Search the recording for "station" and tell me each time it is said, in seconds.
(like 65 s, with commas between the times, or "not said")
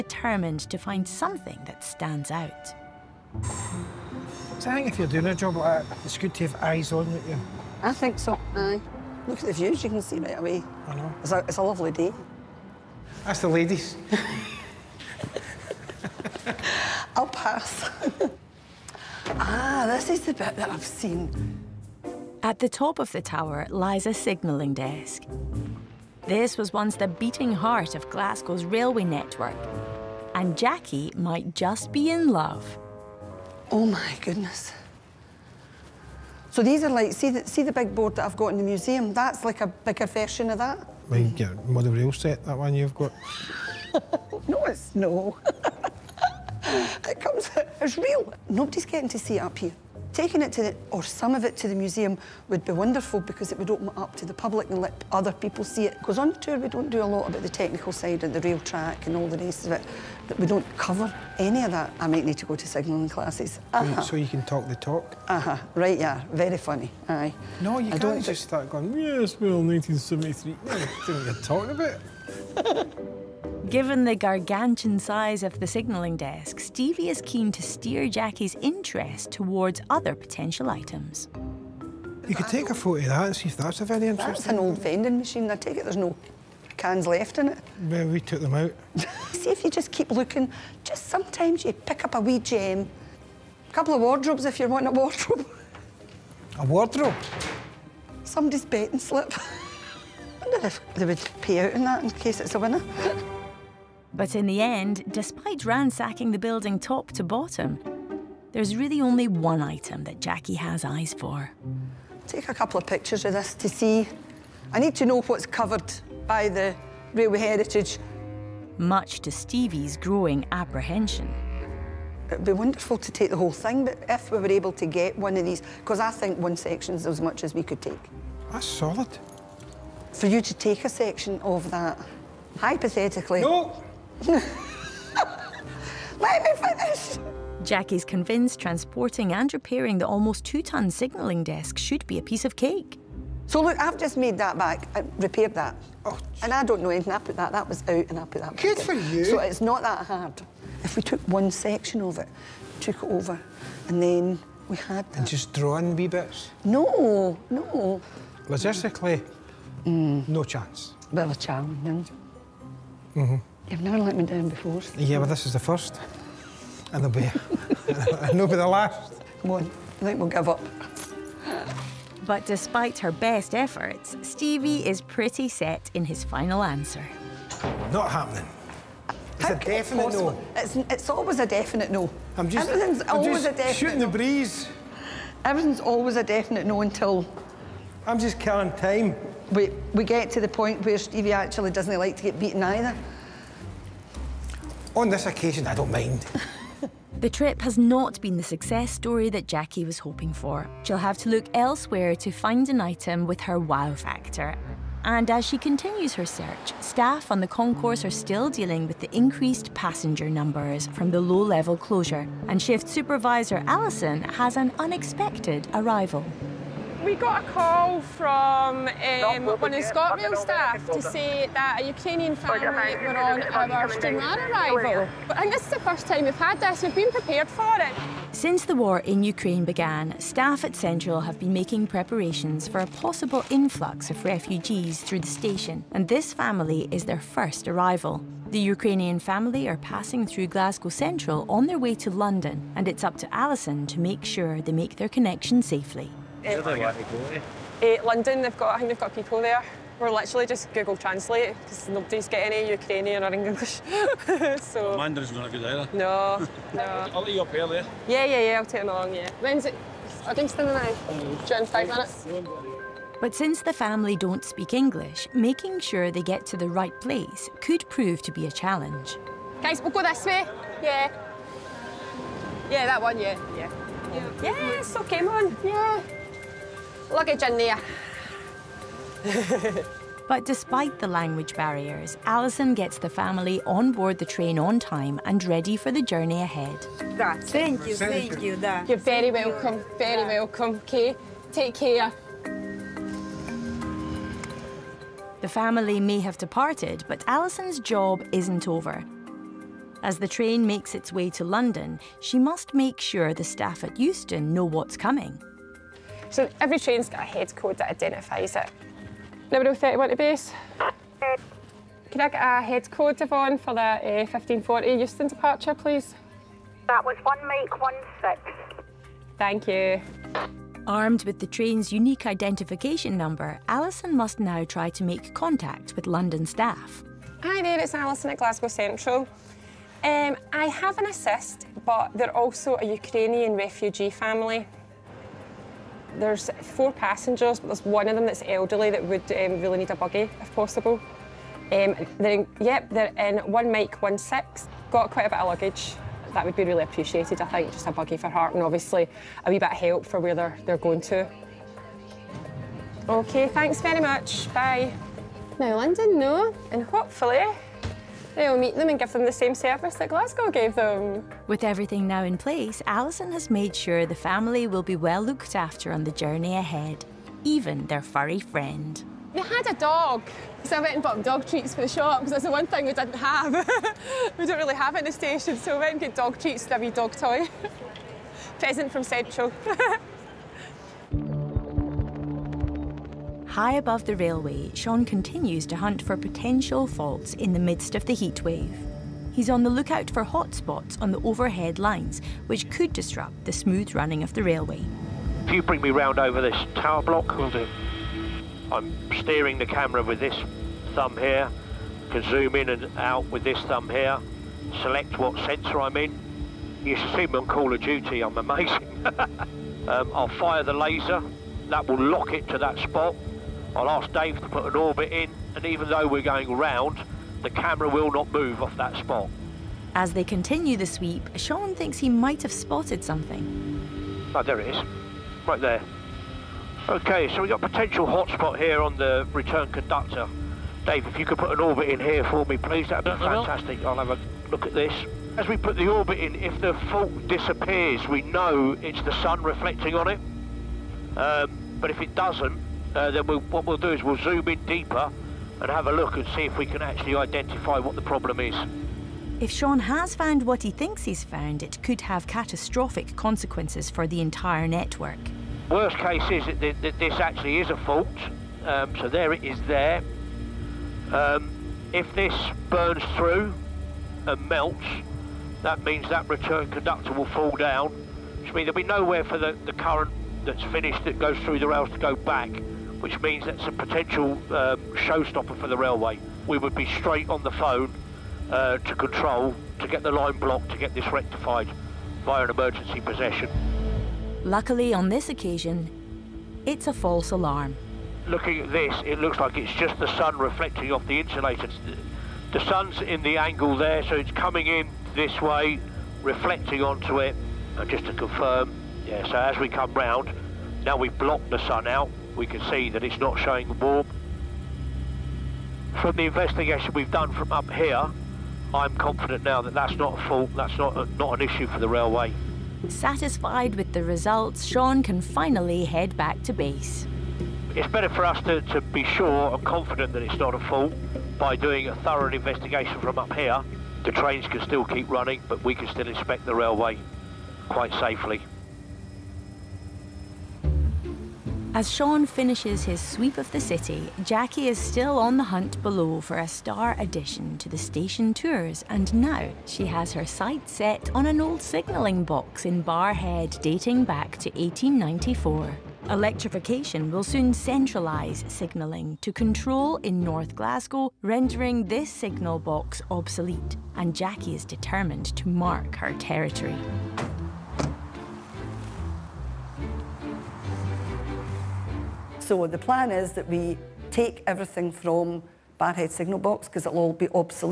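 235 s, 375 s, 537 s.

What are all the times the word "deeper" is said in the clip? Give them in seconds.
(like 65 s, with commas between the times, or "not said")
444 s.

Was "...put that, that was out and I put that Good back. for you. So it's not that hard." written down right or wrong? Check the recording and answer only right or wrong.
right.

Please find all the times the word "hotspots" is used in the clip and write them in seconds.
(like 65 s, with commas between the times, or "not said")
390 s, 428 s.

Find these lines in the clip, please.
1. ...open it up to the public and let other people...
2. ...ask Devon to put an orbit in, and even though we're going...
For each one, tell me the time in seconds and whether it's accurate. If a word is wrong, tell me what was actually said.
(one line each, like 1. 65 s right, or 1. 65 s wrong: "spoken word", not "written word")
1. 53 s right
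2. 413 s wrong: "Dave", not "Devon".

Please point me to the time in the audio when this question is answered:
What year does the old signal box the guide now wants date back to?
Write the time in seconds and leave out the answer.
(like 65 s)
544 s.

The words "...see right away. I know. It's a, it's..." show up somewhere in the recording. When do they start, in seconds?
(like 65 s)
10 s.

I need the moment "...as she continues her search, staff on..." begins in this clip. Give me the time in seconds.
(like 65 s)
205 s.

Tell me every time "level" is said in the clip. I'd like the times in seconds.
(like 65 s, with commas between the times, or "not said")
211 s.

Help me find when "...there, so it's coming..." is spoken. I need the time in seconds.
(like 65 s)
493 s.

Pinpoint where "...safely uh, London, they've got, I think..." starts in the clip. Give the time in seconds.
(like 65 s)
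245 s.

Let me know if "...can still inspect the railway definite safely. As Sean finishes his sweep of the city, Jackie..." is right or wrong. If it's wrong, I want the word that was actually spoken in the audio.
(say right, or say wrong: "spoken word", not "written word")
wrong: "quite", not "definite".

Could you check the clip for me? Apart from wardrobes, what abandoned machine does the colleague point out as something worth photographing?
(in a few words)
vending machine.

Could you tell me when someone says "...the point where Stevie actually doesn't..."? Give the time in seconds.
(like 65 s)
190 s.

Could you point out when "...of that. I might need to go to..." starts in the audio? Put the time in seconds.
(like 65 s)
61 s.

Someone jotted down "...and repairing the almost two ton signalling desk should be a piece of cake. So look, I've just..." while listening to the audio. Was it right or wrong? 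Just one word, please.
right.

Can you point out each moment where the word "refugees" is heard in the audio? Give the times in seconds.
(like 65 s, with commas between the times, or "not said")
234 s, 333 s.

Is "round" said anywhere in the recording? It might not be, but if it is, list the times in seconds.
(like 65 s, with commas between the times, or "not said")
395 s, 416 s, 499 s.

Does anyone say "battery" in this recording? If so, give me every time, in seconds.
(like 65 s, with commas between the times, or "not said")
not said.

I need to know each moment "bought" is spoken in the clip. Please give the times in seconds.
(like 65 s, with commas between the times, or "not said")
371 s.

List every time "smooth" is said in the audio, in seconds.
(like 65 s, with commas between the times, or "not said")
393 s.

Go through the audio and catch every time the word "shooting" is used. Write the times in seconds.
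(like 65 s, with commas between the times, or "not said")
183 s.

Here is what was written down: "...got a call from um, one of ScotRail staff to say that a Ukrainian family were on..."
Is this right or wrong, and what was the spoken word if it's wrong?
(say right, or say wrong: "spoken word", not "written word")
right.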